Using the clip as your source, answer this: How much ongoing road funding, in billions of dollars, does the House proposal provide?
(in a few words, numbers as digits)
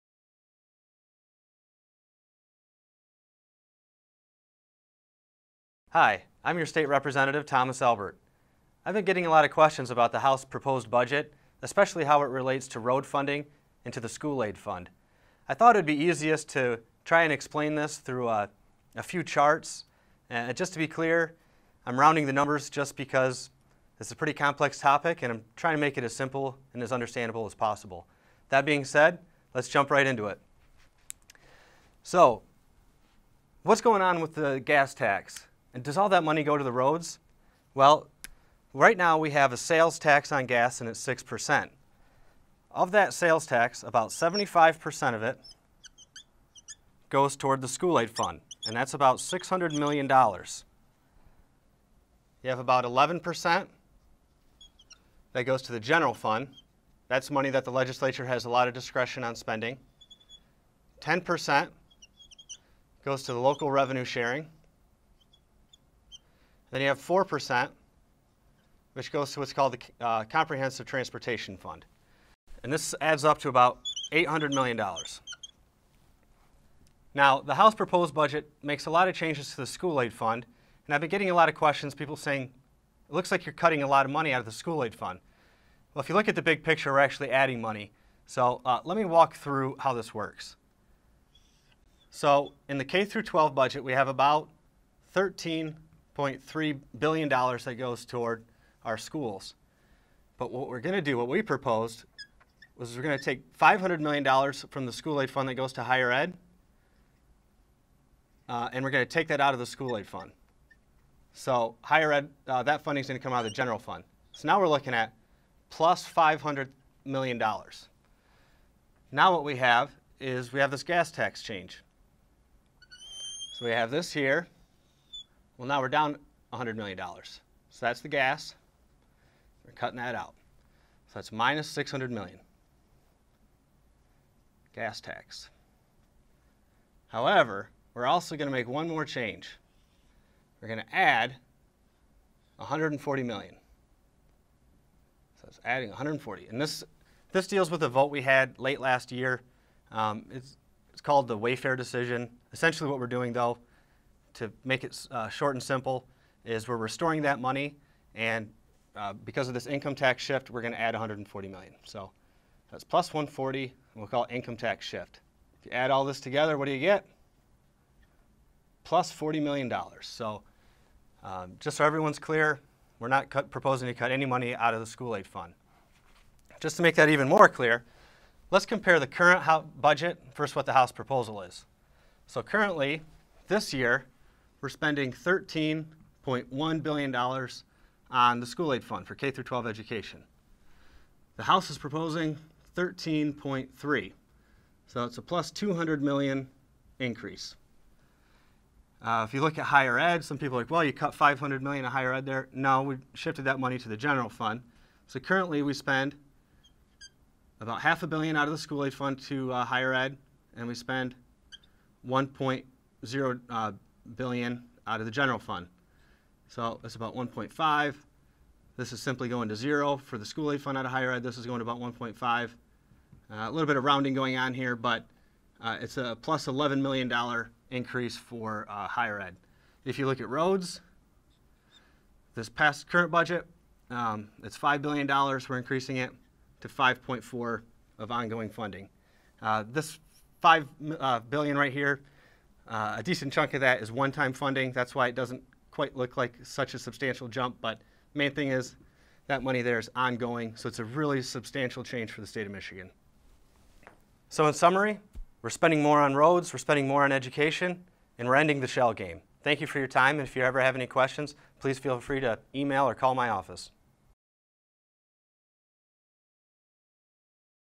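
5.4 billion.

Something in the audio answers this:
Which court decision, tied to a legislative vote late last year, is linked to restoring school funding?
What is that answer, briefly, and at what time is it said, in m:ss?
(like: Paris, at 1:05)
Wayfair decision, at 2:31.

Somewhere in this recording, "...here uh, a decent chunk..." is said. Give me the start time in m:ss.
4:01.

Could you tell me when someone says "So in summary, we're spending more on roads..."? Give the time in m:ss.
4:14.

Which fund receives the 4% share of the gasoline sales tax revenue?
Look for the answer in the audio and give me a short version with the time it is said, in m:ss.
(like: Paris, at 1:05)
Comprehensive Transportation Fund, at 1:10.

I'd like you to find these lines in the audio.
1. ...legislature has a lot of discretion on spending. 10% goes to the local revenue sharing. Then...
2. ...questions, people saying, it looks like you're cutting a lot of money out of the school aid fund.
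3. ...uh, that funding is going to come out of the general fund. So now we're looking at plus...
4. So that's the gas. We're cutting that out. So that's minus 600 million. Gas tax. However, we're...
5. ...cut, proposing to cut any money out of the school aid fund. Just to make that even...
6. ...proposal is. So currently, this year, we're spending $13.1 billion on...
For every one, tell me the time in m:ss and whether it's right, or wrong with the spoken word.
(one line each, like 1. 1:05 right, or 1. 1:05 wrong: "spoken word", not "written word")
1. 0:57 right
2. 1:21 right
3. 1:52 right
4. 2:06 right
5. 2:53 right
6. 3:00 right.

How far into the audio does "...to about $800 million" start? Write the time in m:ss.
1:13.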